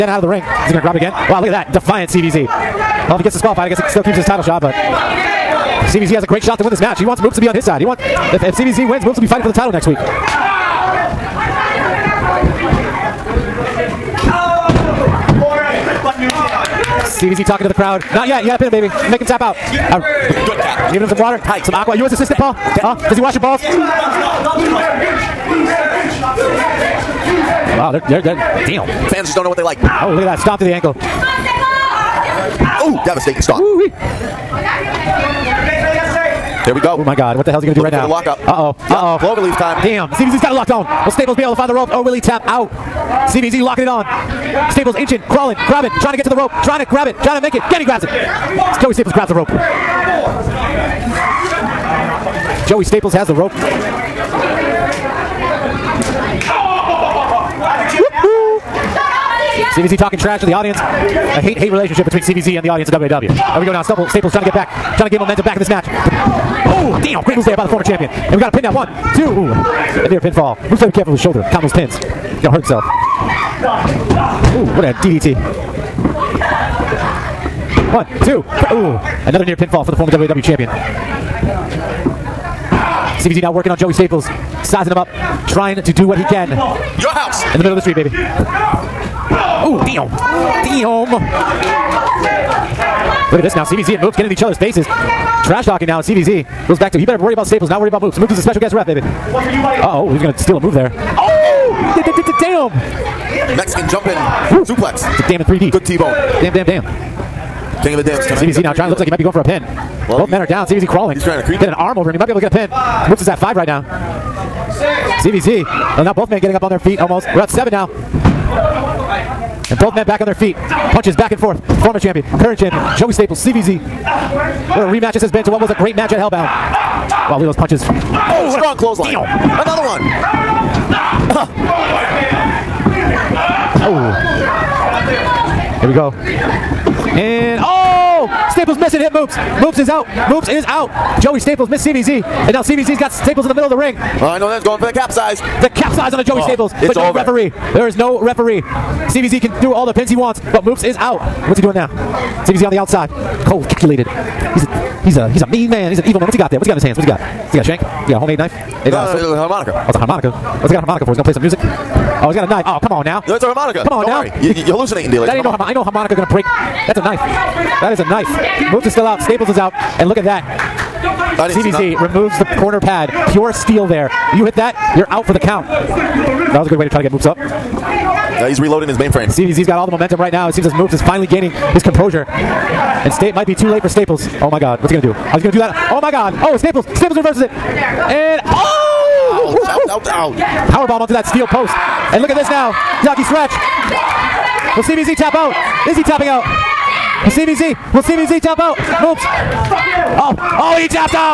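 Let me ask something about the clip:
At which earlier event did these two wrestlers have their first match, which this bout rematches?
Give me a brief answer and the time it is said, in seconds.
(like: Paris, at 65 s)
Hellbound, at 126 s.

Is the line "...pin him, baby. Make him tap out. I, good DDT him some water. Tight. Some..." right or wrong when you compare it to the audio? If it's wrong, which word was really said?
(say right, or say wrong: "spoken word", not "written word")
wrong: "Giving", not "DDT".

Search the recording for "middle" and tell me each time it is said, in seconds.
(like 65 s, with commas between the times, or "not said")
87 s, 143 s.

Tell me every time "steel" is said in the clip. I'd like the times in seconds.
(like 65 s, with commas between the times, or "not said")
173 s, 191 s.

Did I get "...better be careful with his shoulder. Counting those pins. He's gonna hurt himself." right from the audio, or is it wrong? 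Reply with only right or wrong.
right.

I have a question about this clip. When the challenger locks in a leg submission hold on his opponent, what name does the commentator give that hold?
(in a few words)
Cloverleaf.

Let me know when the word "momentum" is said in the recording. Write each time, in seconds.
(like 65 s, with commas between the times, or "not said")
179 s.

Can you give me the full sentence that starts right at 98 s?
Moops is a special guest ref, baby.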